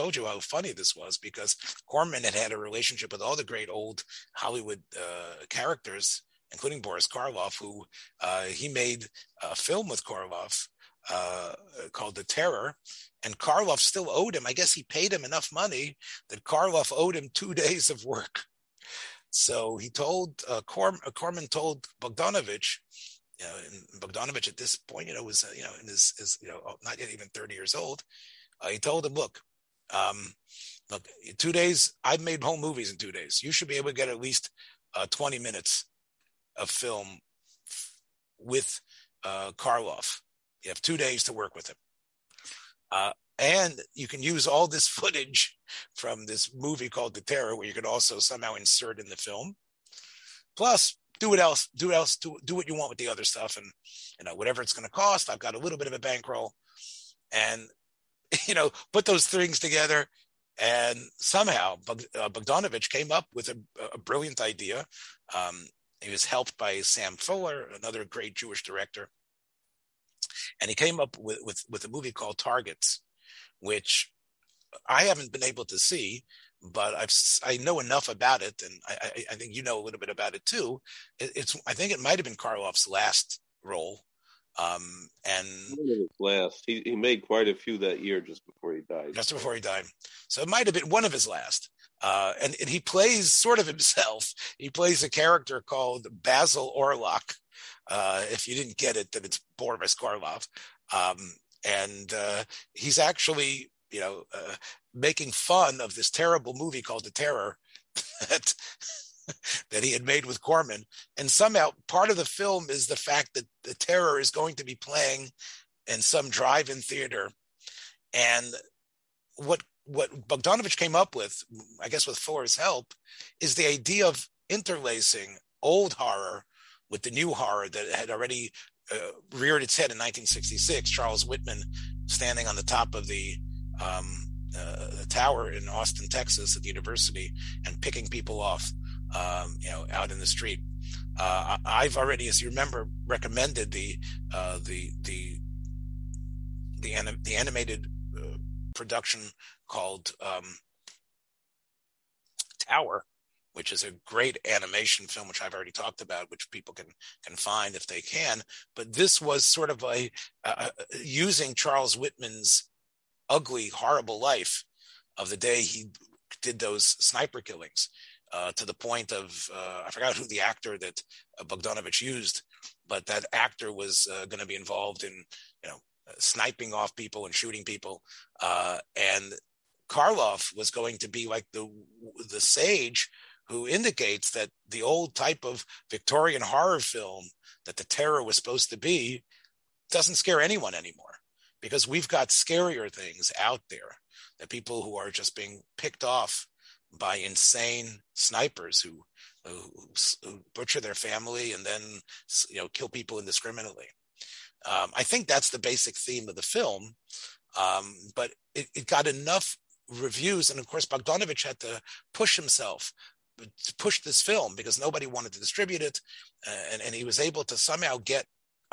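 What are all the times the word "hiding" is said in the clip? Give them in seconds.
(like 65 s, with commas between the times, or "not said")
not said.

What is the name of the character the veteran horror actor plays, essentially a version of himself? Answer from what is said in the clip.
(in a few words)
Basil Orlok.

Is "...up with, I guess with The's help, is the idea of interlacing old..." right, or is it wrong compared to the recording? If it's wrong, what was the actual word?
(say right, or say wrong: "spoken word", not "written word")
wrong: "Fuller", not "The".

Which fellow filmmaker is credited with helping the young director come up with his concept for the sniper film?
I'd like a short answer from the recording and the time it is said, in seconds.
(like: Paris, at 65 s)
Sam Fuller, at 66 s.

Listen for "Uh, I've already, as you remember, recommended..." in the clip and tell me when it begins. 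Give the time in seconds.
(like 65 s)
141 s.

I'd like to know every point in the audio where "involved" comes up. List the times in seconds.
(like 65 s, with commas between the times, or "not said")
174 s.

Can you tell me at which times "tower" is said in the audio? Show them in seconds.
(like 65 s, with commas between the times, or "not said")
135 s, 152 s.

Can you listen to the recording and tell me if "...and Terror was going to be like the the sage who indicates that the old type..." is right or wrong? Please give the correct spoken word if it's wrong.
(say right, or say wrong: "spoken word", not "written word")
wrong: "Karloff", not "Terror".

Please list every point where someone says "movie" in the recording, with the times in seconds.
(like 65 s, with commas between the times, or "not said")
32 s, 46 s, 71 s, 106 s.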